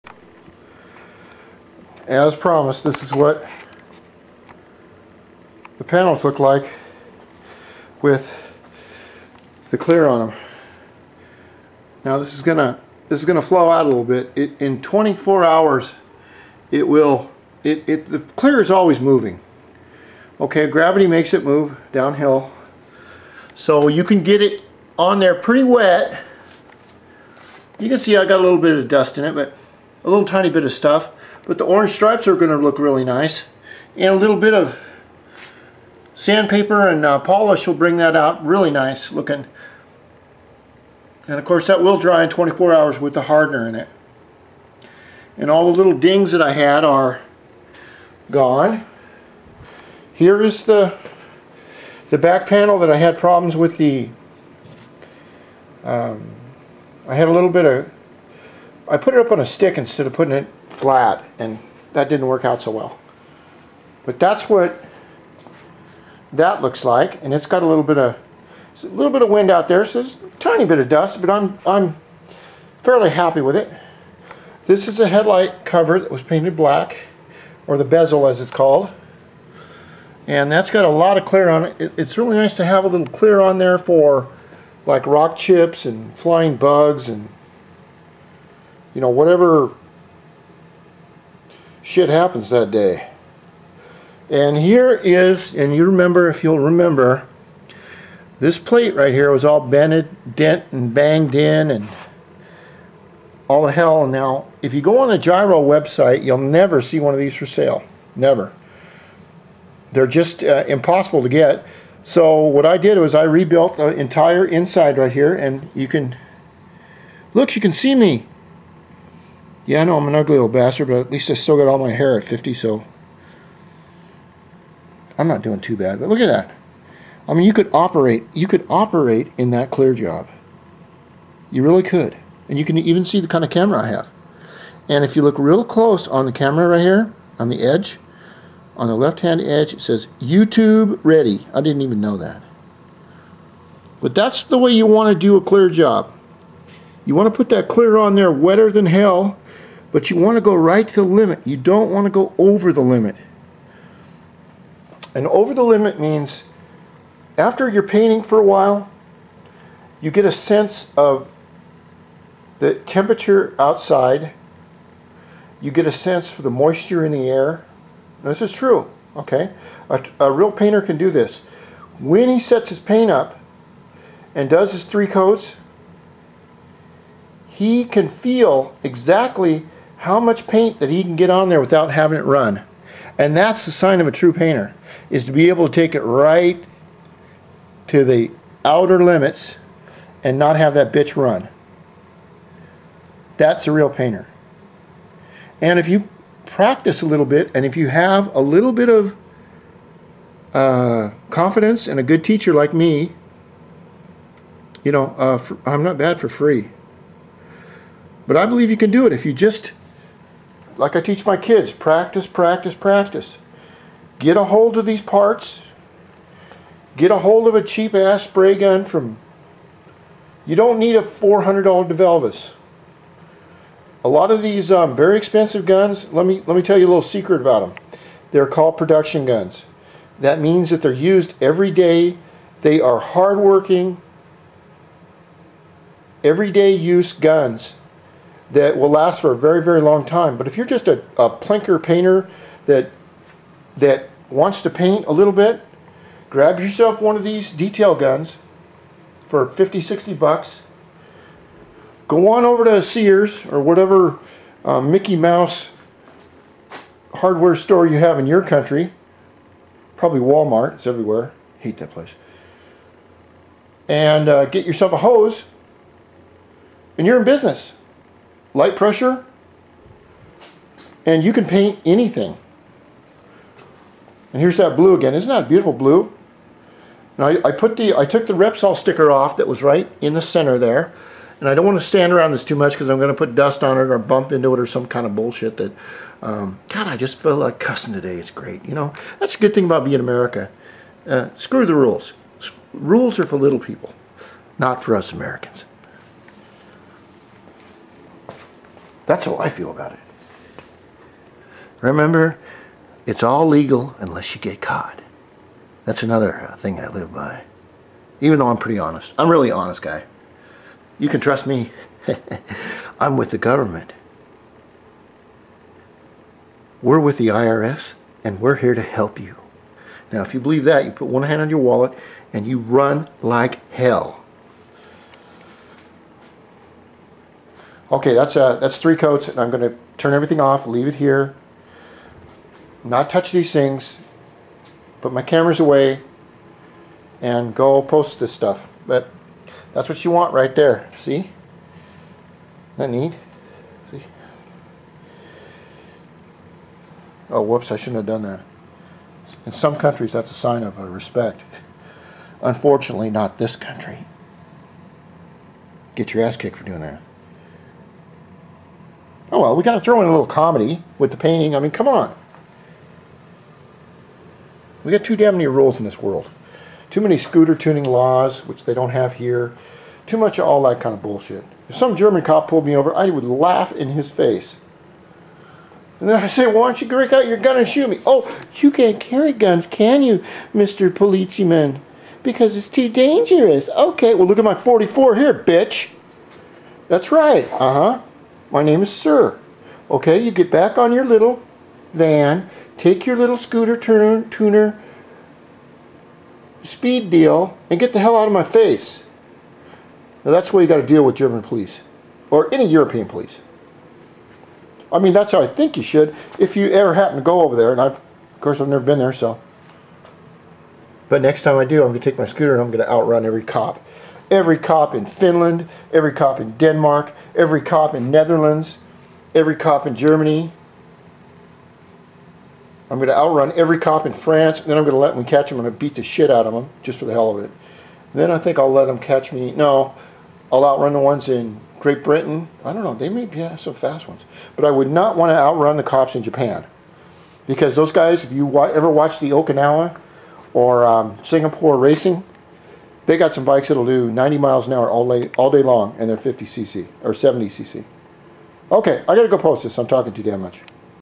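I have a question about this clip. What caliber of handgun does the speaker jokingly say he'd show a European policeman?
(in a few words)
44.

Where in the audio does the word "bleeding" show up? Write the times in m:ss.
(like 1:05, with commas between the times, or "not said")
not said.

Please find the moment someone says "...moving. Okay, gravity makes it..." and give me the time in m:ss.
0:18.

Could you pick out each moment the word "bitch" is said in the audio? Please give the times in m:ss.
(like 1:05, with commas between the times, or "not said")
3:10, 6:25.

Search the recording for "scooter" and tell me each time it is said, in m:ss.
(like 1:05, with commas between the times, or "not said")
6:07, 6:33, 6:52.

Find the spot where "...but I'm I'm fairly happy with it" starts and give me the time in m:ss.
1:11.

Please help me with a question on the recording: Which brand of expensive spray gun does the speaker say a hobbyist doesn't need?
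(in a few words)
DeVilbiss.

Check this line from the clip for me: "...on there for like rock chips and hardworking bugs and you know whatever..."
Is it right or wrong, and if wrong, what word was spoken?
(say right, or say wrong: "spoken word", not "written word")
wrong: "flying", not "hardworking".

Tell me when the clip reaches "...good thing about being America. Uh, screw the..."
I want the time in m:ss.
4:49.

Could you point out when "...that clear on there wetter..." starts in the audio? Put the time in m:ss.
2:27.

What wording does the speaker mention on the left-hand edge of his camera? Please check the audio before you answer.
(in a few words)
YouTube ready.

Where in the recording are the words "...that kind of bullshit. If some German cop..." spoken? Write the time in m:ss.
6:10.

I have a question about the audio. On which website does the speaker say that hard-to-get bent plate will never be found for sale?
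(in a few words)
Gyro.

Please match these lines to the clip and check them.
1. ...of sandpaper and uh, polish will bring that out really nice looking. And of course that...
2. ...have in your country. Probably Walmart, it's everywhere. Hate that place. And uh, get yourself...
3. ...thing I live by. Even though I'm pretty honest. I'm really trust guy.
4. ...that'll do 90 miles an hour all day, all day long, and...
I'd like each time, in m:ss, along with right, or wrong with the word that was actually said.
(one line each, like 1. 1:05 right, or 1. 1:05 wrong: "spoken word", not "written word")
1. 0:34 right
2. 4:17 right
3. 5:06 wrong: "honest", not "trust"
4. 7:23 right.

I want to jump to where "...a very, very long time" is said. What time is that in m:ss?
3:59.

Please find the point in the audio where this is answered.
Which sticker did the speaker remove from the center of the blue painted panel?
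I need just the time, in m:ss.
4:38.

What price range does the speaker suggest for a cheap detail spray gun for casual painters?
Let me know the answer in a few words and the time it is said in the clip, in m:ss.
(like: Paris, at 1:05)
50 to 60 dollars, at 4:09.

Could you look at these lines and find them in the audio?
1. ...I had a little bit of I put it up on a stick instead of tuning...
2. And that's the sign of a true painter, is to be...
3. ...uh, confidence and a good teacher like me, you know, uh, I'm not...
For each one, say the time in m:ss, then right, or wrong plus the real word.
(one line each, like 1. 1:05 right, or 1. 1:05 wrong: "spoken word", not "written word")
1. 0:57 wrong: "putting", not "tuning"
2. 3:03 right
3. 3:20 right.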